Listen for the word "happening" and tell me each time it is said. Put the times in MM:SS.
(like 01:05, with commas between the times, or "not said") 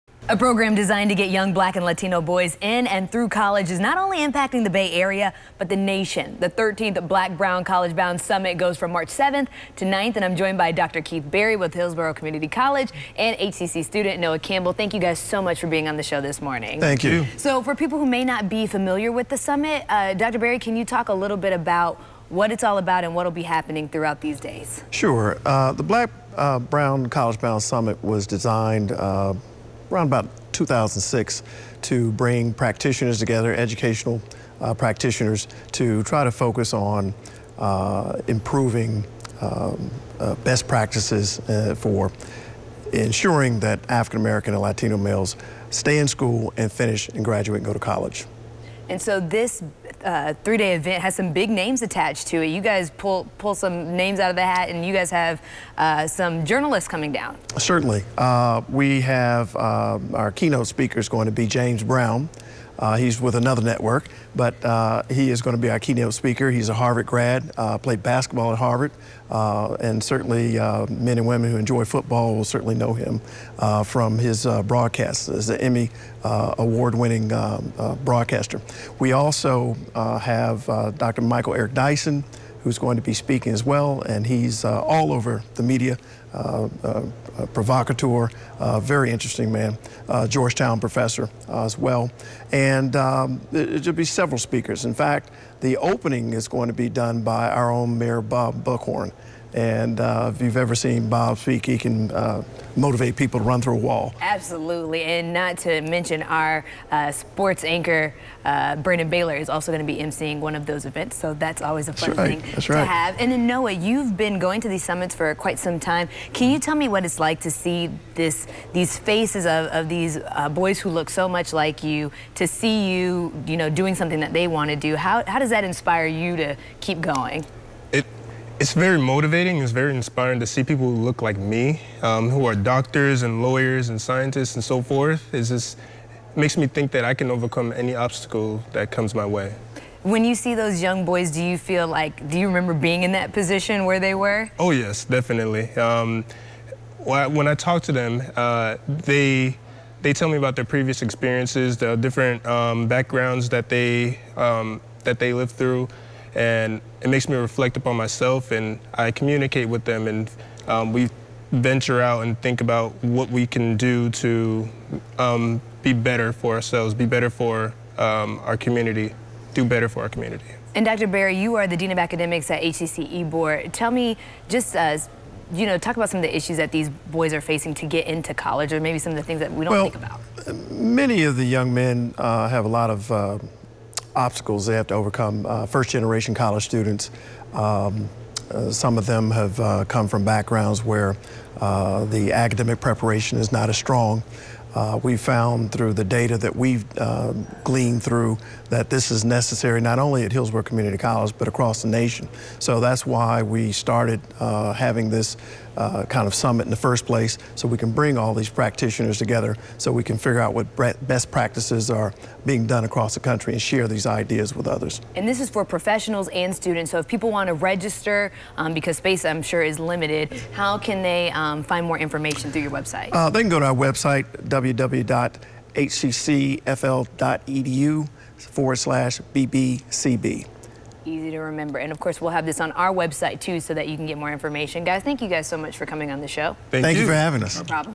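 00:23.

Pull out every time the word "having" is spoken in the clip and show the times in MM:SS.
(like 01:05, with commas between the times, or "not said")
03:24, 03:57.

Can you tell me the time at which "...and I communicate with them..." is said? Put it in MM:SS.
02:38.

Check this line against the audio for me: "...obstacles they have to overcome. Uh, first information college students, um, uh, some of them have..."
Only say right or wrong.
wrong.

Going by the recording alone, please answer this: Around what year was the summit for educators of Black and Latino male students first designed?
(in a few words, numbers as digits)
2006.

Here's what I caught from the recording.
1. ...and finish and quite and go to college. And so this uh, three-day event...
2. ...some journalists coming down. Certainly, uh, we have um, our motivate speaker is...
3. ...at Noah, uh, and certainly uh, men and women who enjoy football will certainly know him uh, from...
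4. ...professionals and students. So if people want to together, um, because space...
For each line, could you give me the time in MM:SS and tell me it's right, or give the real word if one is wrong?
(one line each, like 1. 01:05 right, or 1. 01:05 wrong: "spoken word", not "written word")
1. 00:46 wrong: "graduate", not "quite"
2. 00:56 wrong: "keynote", not "motivate"
3. 01:08 wrong: "Harvard", not "Noah"
4. 03:35 wrong: "register", not "together".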